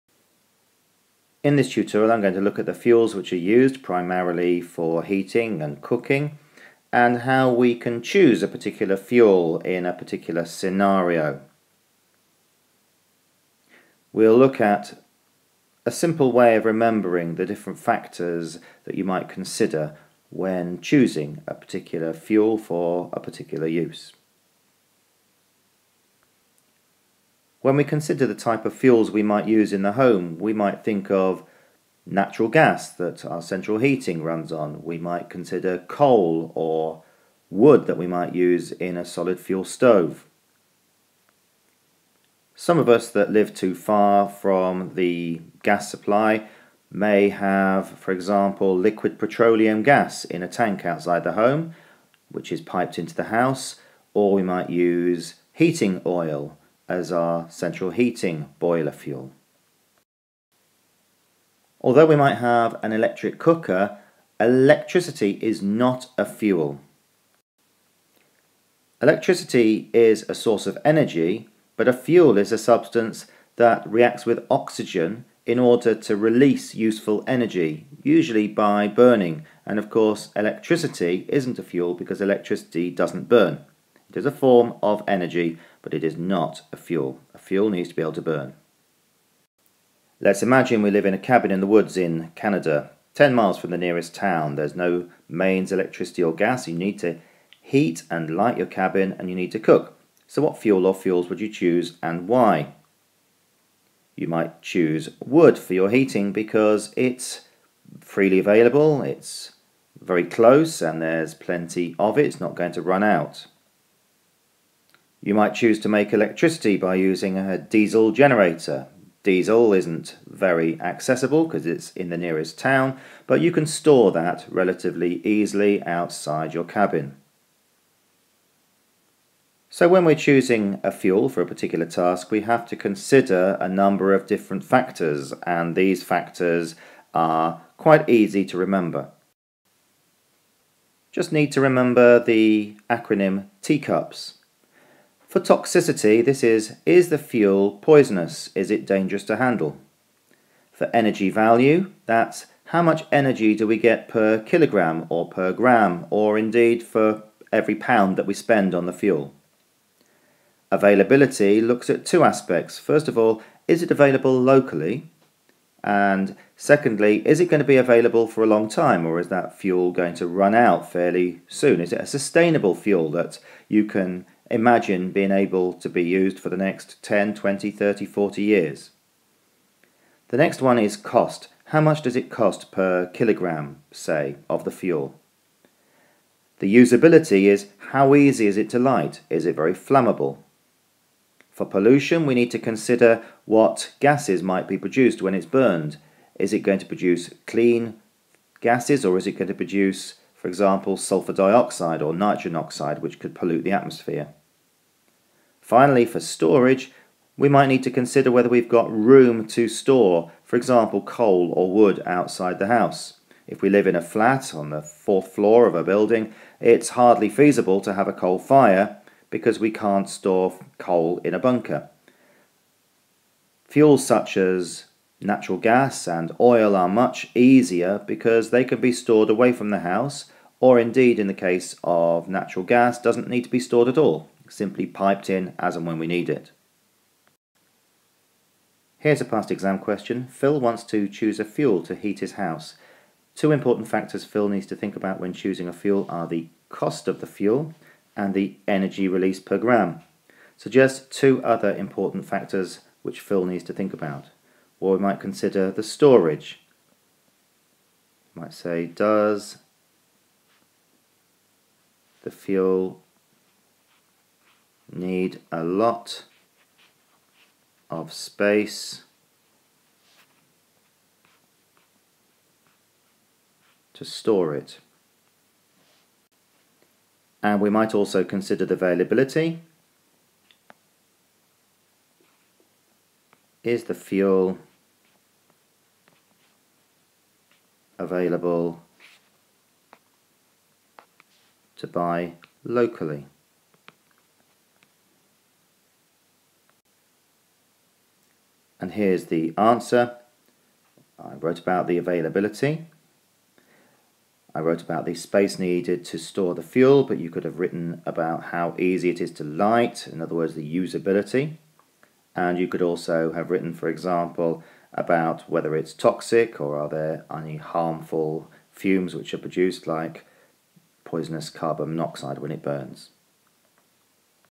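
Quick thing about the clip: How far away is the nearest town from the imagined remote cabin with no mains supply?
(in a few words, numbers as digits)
10.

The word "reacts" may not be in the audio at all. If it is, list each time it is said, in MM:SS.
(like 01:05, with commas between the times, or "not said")
01:13.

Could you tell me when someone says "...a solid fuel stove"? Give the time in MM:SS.
00:38.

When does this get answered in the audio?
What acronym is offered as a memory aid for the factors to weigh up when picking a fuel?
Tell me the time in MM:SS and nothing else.
02:23.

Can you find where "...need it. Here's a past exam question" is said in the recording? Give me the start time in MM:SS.
03:56.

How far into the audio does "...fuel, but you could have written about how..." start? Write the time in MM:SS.
05:06.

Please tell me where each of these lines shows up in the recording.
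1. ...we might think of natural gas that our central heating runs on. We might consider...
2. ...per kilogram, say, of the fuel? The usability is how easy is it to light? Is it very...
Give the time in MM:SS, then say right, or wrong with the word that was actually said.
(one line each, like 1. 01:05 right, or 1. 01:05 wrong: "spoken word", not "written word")
1. 00:30 right
2. 03:02 right.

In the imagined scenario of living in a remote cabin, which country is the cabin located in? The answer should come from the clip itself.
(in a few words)
Canada.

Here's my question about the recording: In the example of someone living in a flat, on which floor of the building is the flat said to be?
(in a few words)
Fourth floor.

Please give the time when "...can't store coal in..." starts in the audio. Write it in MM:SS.
03:39.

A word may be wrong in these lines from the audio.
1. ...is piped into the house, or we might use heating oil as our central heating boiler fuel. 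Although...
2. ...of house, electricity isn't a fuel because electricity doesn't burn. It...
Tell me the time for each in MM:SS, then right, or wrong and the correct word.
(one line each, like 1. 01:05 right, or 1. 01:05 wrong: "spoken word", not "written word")
1. 00:52 right
2. 01:19 wrong: "course", not "house".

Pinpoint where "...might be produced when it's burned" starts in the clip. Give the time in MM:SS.
03:14.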